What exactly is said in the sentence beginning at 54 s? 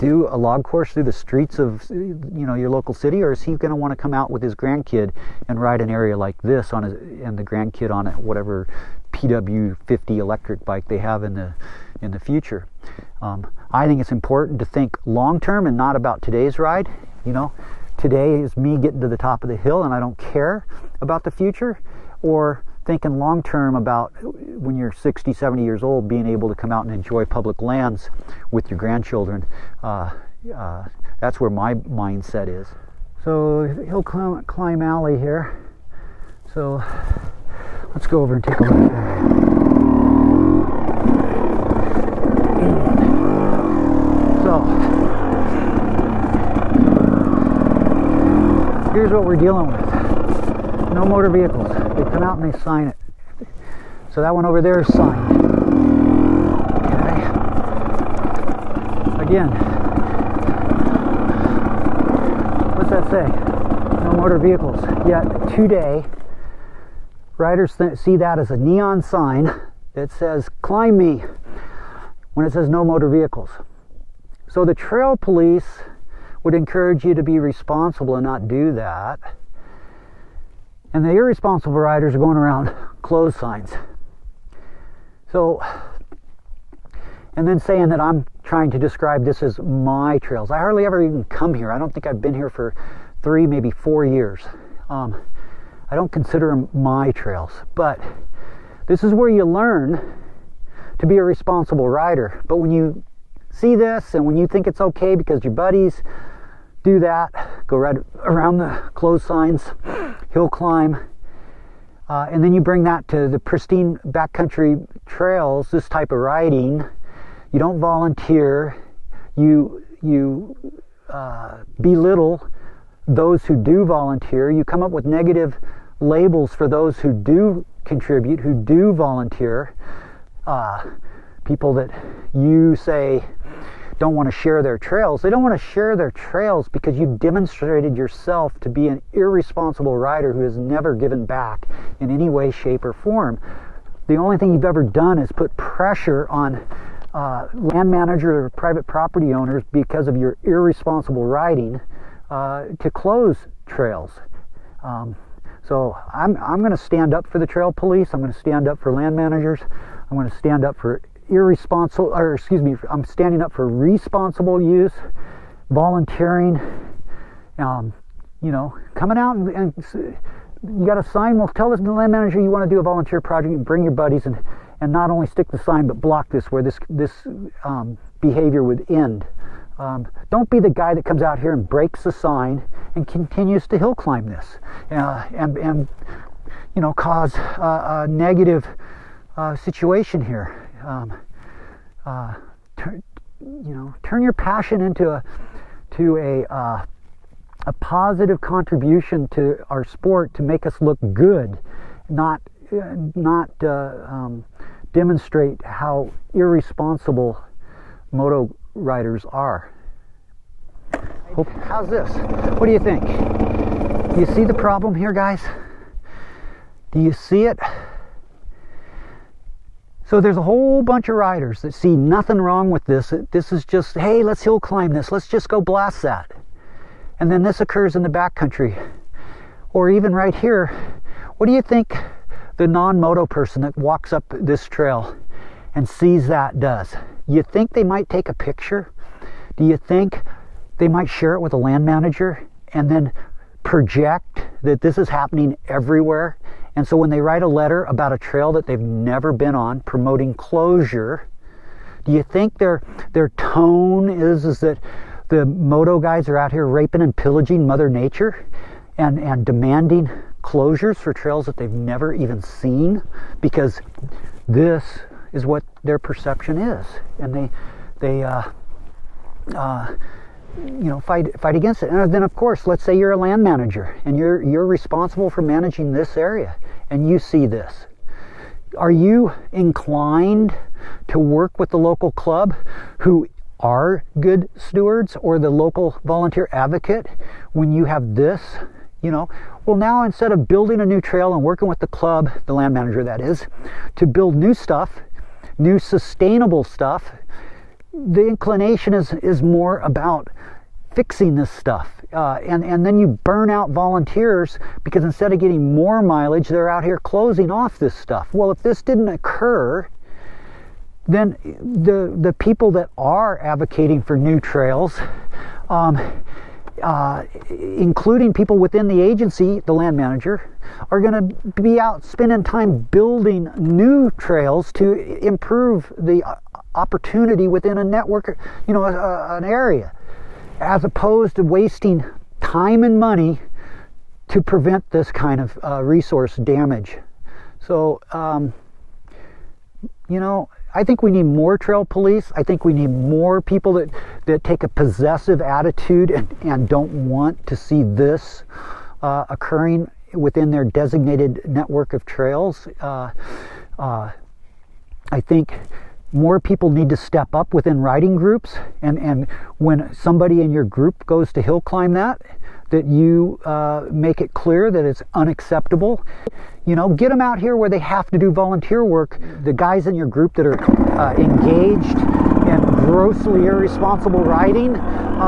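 So that one over there is signed.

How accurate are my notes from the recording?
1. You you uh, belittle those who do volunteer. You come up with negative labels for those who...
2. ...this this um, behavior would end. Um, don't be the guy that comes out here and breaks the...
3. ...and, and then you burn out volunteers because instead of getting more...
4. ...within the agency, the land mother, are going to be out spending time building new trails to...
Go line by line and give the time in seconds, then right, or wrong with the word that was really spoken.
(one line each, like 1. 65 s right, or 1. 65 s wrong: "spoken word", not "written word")
1. 119 s right
2. 176 s right
3. 302 s right
4. 318 s wrong: "manager", not "mother".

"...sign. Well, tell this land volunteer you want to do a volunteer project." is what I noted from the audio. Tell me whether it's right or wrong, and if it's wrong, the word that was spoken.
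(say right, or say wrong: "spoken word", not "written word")
wrong: "manager", not "volunteer".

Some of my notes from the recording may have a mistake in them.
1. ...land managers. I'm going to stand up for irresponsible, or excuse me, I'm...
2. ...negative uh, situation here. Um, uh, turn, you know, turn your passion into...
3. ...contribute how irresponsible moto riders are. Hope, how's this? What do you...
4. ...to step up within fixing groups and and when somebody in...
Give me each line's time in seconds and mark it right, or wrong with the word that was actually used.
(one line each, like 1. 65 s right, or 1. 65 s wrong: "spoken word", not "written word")
1. 158 s right
2. 188 s right
3. 204 s wrong: "demonstrate", not "contribute"
4. 356 s wrong: "riding", not "fixing".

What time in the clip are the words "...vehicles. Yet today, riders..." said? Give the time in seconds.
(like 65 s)
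64 s.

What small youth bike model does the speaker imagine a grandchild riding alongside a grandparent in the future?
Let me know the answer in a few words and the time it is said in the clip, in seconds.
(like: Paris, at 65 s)
PW50, at 9 s.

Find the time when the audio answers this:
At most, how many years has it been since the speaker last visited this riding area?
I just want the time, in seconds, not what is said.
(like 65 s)
93 s.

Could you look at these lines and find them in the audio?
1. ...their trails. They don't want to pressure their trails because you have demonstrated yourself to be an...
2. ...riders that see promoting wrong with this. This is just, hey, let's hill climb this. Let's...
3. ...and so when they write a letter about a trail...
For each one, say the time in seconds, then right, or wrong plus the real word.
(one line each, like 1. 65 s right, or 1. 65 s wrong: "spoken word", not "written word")
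1. 134 s wrong: "share", not "pressure"
2. 221 s wrong: "nothing", not "promoting"
3. 246 s right.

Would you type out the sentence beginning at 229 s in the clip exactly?
Or even right here, what do you think the non-moto person that walks up this trail and sees that does?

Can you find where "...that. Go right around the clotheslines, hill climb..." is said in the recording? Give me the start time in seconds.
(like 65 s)
107 s.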